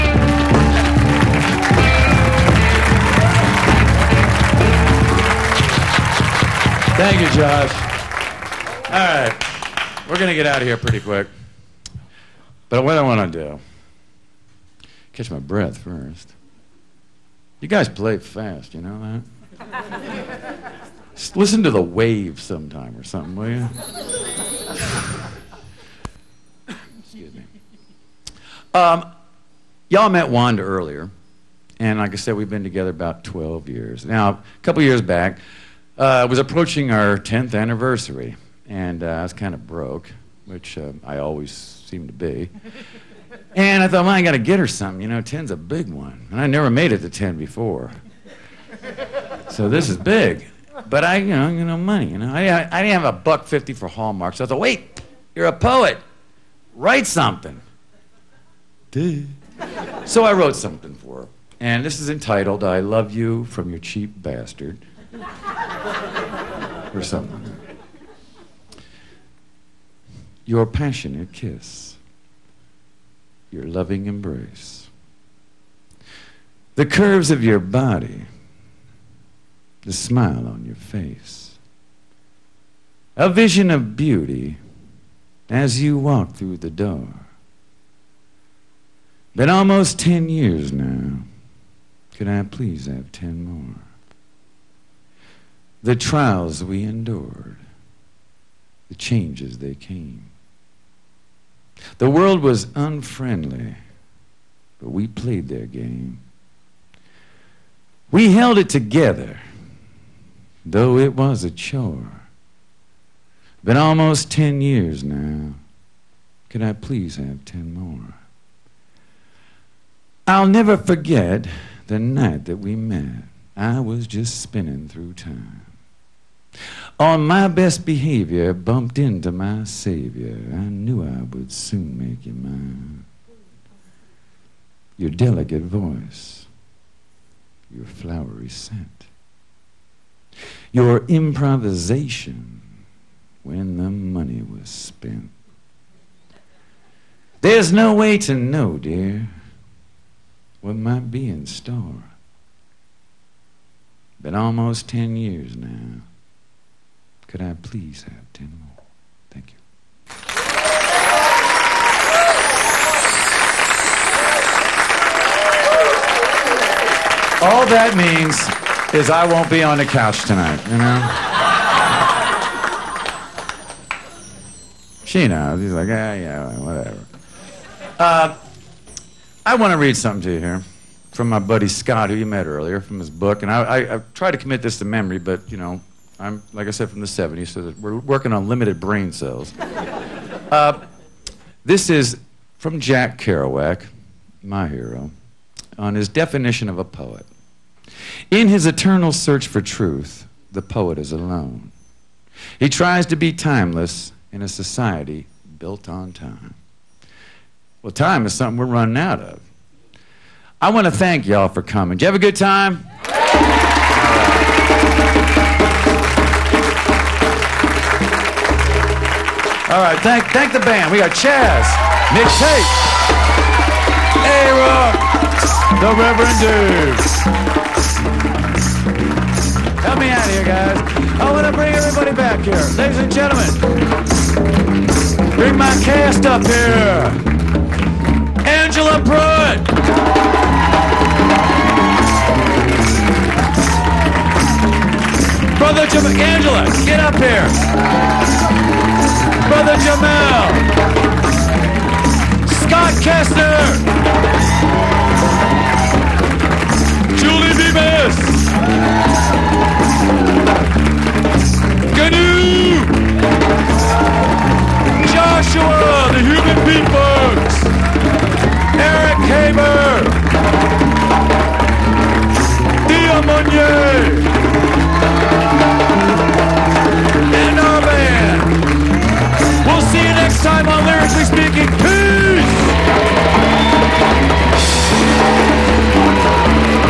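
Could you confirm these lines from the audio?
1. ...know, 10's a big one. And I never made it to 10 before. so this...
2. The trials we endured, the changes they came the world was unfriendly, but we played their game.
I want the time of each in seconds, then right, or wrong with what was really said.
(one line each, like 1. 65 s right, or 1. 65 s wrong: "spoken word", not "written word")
1. 45 s right
2. 95 s right.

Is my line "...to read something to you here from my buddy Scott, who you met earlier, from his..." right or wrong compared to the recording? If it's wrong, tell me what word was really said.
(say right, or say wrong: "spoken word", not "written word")
right.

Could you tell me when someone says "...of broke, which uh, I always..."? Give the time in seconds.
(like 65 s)
39 s.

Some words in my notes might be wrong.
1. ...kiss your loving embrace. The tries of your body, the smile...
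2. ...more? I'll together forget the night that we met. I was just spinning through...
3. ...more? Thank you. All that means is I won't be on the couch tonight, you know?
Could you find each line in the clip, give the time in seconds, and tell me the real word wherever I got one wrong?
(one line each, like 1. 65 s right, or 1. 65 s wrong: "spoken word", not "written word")
1. 71 s wrong: "curves", not "tries"
2. 117 s wrong: "never", not "together"
3. 158 s right.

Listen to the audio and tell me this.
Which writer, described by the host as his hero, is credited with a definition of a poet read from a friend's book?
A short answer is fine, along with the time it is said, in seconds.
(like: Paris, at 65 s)
Jack Kerouac, at 192 s.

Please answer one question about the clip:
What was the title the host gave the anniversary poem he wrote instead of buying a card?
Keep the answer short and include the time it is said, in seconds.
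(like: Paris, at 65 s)
I Love You From Your Cheap Bastard, at 62 s.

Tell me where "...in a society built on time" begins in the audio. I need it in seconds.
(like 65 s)
204 s.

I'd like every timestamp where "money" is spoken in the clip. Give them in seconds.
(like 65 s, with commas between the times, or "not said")
51 s, 143 s.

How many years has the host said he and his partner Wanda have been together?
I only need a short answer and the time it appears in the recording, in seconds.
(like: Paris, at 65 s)
12, at 33 s.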